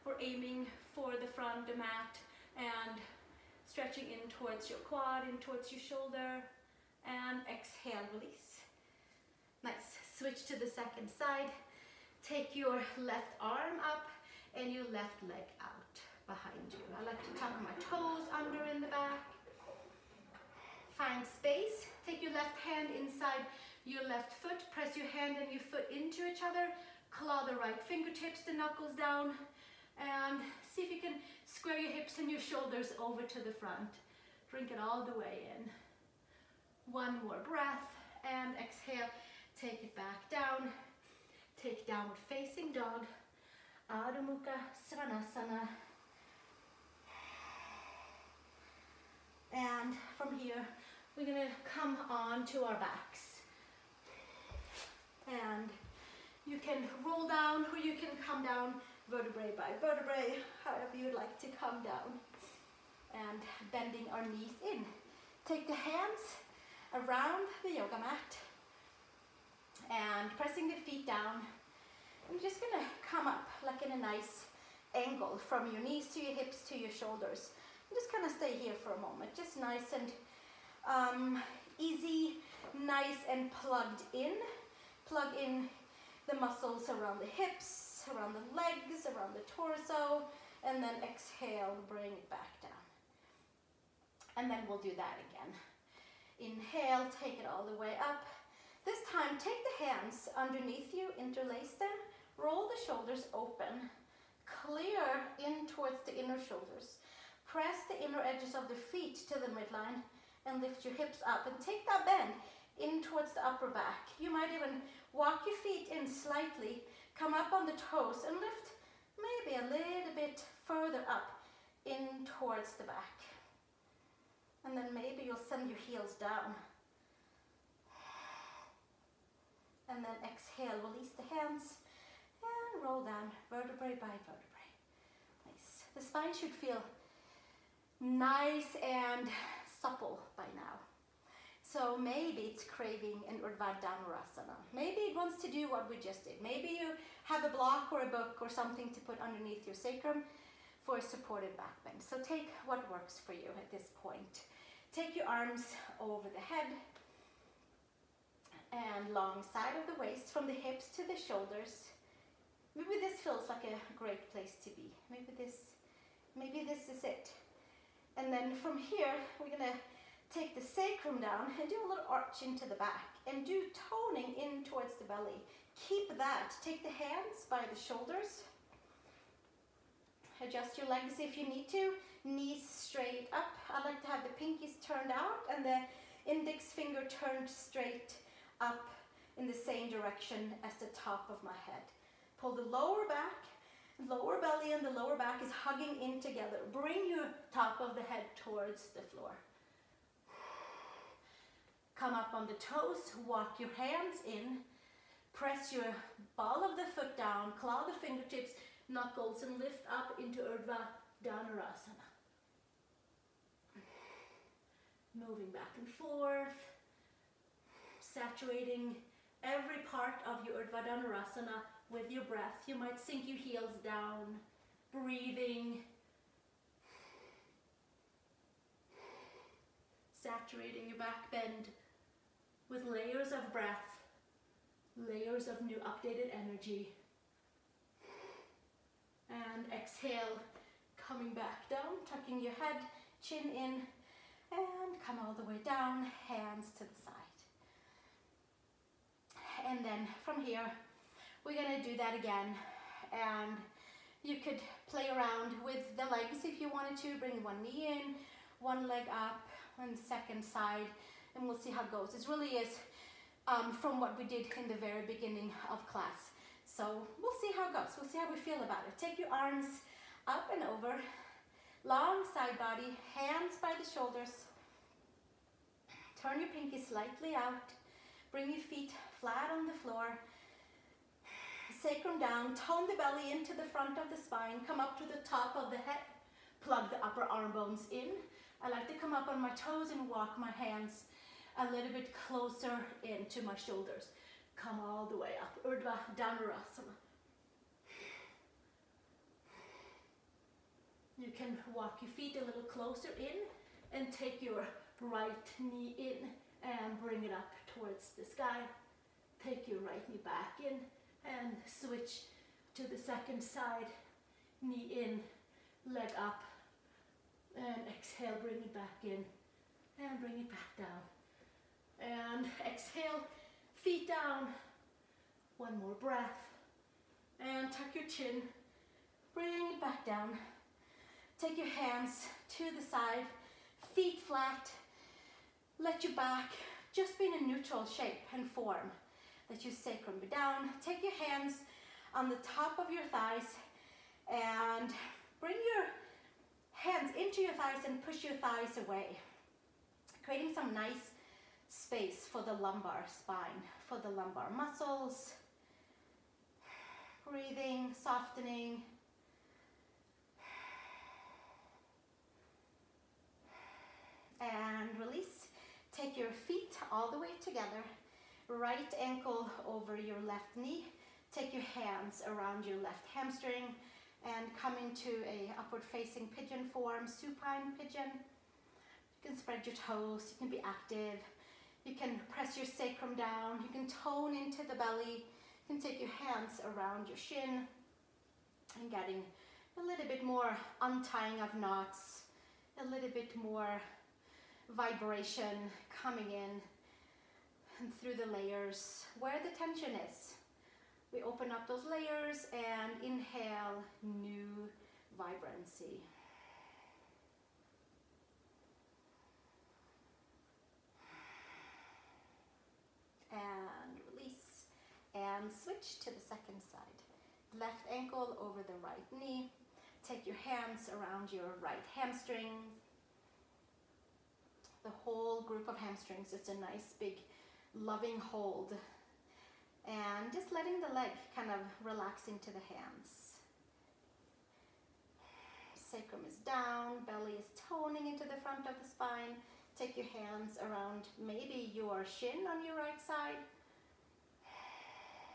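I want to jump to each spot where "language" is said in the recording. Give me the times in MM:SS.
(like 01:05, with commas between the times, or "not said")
not said.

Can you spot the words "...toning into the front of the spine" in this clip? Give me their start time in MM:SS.
07:17.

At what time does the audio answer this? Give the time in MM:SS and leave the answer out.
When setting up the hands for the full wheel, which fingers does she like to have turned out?
03:04.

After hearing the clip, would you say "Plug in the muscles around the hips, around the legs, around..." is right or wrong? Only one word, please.
right.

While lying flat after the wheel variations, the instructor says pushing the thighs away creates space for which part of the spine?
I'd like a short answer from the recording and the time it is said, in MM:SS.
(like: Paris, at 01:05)
The lumbar spine, at 05:52.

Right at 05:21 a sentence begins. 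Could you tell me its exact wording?
And exhale, feet down, one more breath, and tuck your chin, bring it back down.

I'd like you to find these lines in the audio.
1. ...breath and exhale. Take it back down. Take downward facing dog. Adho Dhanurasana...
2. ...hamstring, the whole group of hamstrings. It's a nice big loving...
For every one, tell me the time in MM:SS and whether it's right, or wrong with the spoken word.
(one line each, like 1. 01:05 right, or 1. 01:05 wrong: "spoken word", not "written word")
1. 00:37 wrong: "Mukha", not "Dhanurasana"
2. 07:01 right.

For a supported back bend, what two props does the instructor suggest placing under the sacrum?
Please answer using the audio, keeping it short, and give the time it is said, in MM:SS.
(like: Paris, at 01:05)
A block or a book, at 02:27.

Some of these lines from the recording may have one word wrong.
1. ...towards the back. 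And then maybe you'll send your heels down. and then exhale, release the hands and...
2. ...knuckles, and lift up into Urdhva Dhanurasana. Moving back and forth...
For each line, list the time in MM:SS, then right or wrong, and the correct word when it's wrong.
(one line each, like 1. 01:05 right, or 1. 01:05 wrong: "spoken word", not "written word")
1. 02:02 right
2. 03:28 right.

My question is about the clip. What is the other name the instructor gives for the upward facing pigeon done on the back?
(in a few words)
Supine pigeon.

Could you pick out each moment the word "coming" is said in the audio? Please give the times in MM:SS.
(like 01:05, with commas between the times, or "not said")
04:00, 06:36.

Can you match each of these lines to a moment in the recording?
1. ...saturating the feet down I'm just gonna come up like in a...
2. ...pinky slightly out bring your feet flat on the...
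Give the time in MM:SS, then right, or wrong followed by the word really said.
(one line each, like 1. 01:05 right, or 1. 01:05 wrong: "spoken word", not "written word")
1. 01:10 wrong: "pressing", not "saturating"
2. 04:36 right.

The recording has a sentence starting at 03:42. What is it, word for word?
You might sink your heels down, breathing, saturating your back bend with layers of breath, layers of new updated energy.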